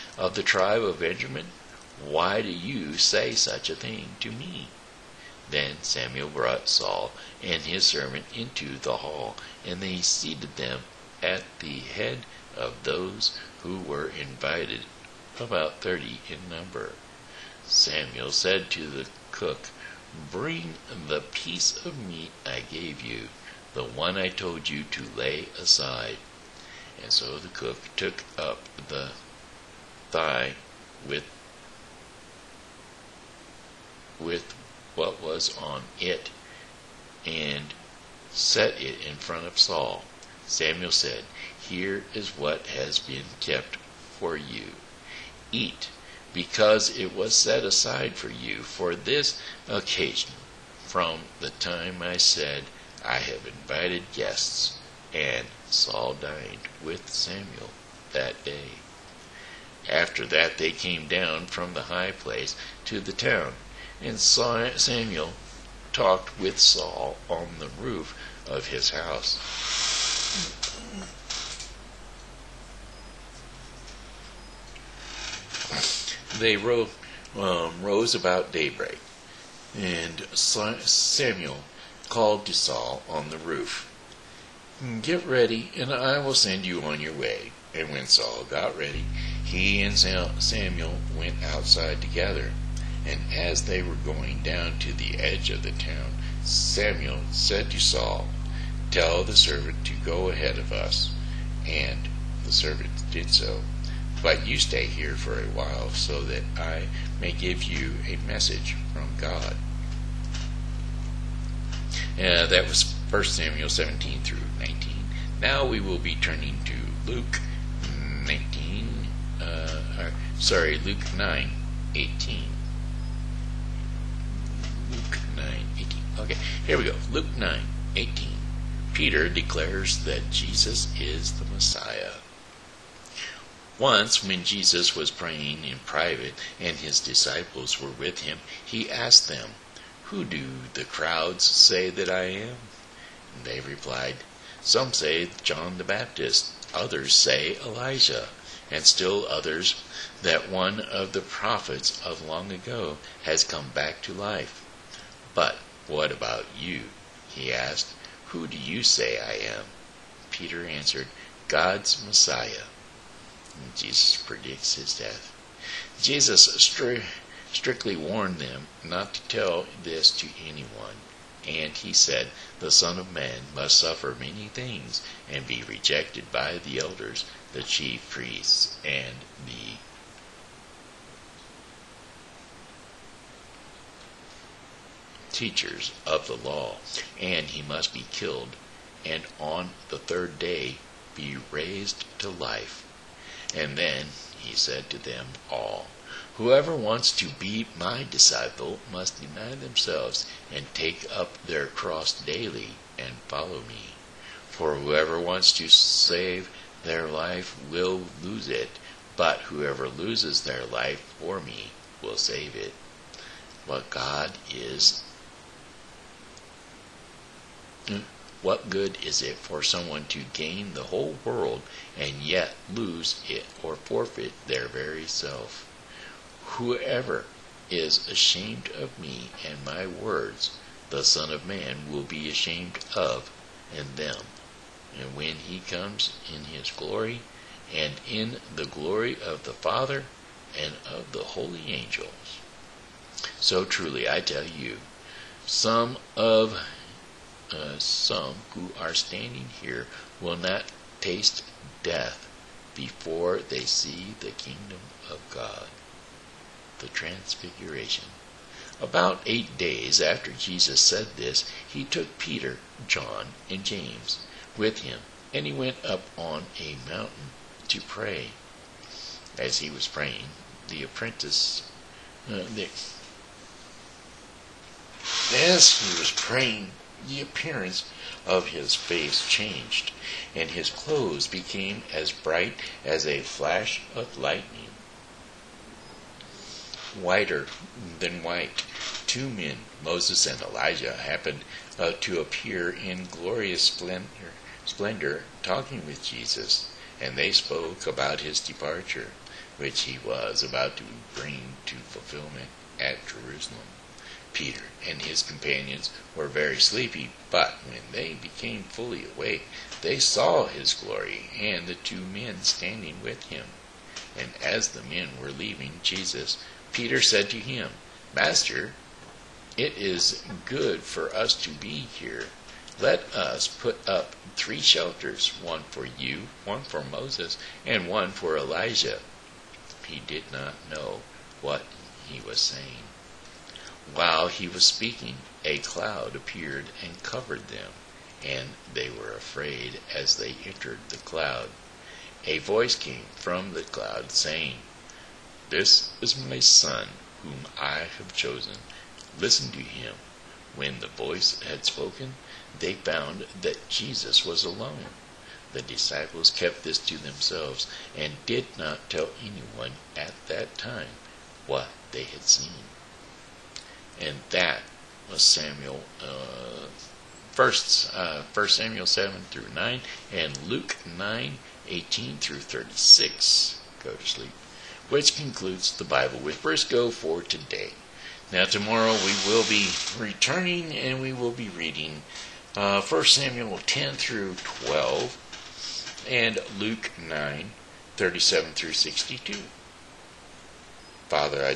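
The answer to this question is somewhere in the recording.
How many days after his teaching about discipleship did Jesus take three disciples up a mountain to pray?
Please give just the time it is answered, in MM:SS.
04:19.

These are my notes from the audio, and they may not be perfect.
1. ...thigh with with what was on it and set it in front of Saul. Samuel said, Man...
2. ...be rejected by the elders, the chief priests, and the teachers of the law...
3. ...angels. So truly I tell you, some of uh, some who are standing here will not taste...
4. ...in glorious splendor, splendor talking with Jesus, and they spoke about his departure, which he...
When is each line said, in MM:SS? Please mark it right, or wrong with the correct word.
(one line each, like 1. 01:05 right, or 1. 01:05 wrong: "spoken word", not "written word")
1. 00:30 wrong: "Here", not "Man"
2. 02:55 right
3. 04:01 right
4. 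04:52 right.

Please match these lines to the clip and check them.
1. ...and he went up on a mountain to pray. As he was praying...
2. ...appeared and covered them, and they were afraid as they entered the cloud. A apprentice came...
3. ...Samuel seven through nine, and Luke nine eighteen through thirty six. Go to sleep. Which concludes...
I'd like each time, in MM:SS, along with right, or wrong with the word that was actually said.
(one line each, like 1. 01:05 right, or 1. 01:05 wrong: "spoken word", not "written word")
1. 04:25 right
2. 05:36 wrong: "voice", not "apprentice"
3. 06:08 right.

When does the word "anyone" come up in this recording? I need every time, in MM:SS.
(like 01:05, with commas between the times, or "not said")
02:50, 05:59.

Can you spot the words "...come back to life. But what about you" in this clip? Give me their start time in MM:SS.
02:33.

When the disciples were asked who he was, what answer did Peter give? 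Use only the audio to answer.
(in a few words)
God's Messiah.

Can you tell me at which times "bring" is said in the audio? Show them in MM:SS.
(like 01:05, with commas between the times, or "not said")
00:20, 05:01.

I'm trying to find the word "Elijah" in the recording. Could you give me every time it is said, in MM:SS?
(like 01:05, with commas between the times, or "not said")
02:27, 04:50, 05:28.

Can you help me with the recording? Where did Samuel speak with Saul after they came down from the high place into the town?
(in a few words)
On the roof of his house.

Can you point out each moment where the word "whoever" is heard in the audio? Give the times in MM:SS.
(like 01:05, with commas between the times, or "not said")
03:16, 03:24, 03:29, 03:46.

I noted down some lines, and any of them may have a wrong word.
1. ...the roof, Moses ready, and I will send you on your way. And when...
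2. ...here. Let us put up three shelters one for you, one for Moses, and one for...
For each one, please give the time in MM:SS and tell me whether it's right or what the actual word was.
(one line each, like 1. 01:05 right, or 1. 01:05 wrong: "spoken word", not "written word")
1. 01:23 wrong: "Get", not "Moses"
2. 05:21 right.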